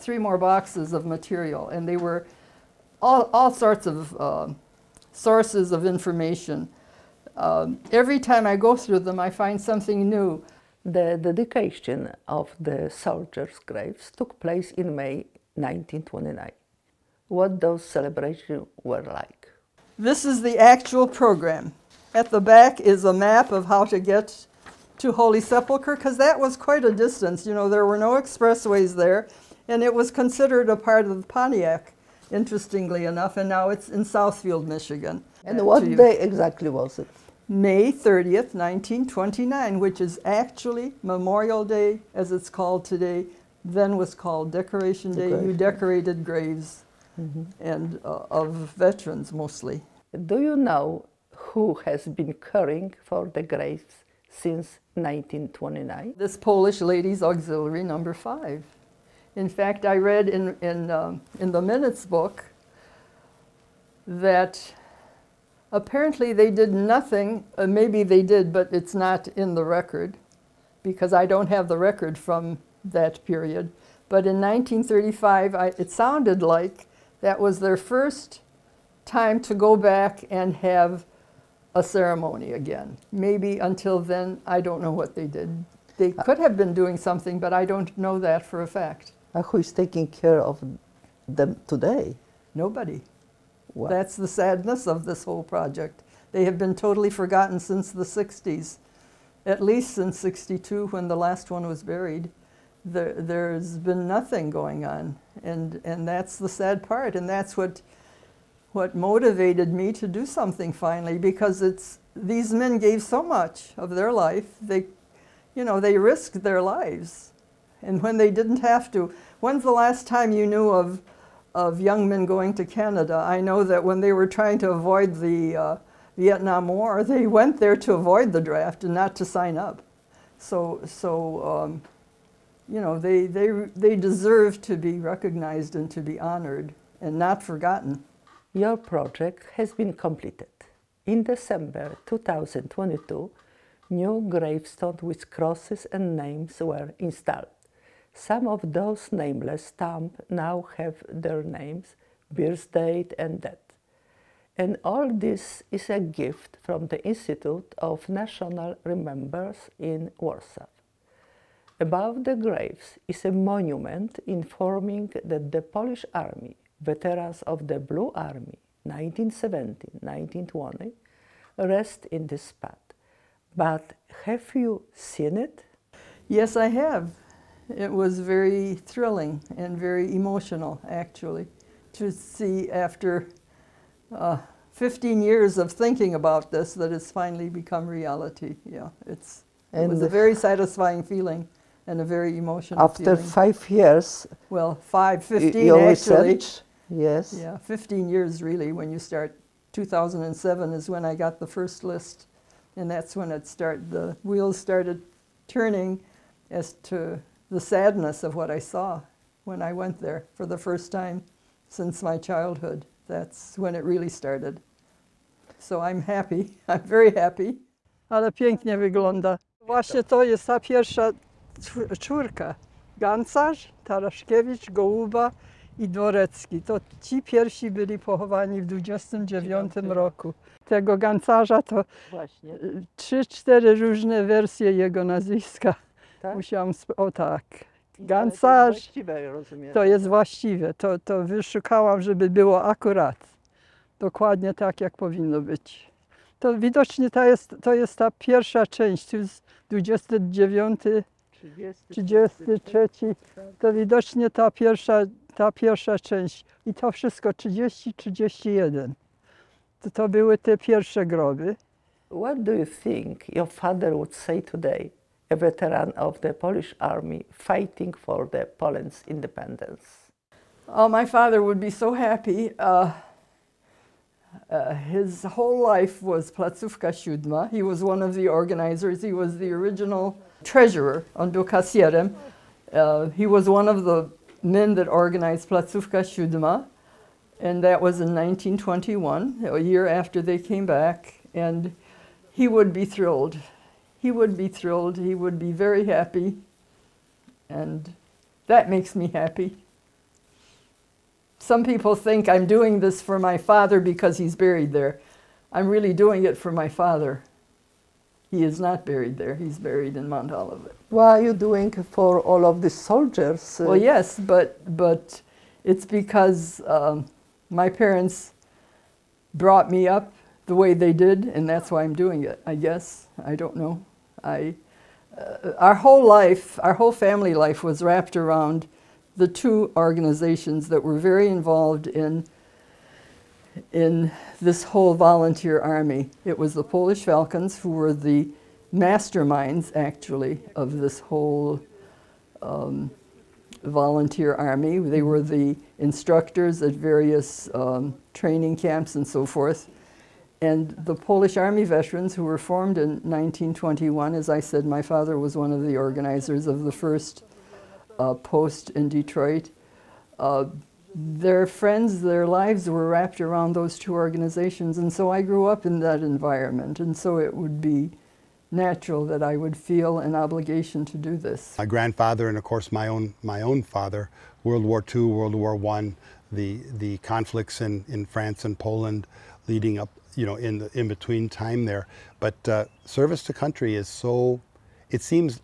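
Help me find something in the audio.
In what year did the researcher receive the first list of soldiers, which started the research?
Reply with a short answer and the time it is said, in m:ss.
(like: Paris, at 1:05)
2007, at 3:19.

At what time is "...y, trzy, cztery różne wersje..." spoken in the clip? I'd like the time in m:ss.
3:52.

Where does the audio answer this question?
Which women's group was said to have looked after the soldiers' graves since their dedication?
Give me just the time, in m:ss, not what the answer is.
0:56.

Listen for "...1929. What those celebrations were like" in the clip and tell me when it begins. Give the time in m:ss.
0:15.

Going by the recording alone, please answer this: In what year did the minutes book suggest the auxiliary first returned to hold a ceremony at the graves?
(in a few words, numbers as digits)
1935.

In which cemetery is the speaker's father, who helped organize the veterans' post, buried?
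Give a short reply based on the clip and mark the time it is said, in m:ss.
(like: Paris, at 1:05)
Mount Olivet, at 5:10.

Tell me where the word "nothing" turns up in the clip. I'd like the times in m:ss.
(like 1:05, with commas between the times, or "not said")
1:06, 1:44.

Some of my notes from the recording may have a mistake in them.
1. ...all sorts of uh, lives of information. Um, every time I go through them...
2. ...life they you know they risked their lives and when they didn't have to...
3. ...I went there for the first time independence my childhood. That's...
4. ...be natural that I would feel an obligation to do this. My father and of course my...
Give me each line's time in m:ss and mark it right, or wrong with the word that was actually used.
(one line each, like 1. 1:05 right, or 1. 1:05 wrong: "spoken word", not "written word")
1. 0:03 wrong: "sources", not "lives"
2. 1:54 right
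3. 3:29 wrong: "since", not "independence"
4. 6:07 wrong: "grandfather", not "father".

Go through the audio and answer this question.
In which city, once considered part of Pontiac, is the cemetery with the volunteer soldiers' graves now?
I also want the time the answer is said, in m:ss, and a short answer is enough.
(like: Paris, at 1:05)
Southfield, Michigan, at 0:34.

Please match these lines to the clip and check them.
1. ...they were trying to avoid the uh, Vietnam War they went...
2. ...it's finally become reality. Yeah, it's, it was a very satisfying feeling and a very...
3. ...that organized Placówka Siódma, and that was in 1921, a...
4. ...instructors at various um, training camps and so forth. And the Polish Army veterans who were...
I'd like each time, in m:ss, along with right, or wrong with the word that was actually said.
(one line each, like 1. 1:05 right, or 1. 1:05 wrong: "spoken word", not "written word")
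1. 2:04 right
2. 3:06 right
3. 4:44 right
4. 5:45 right.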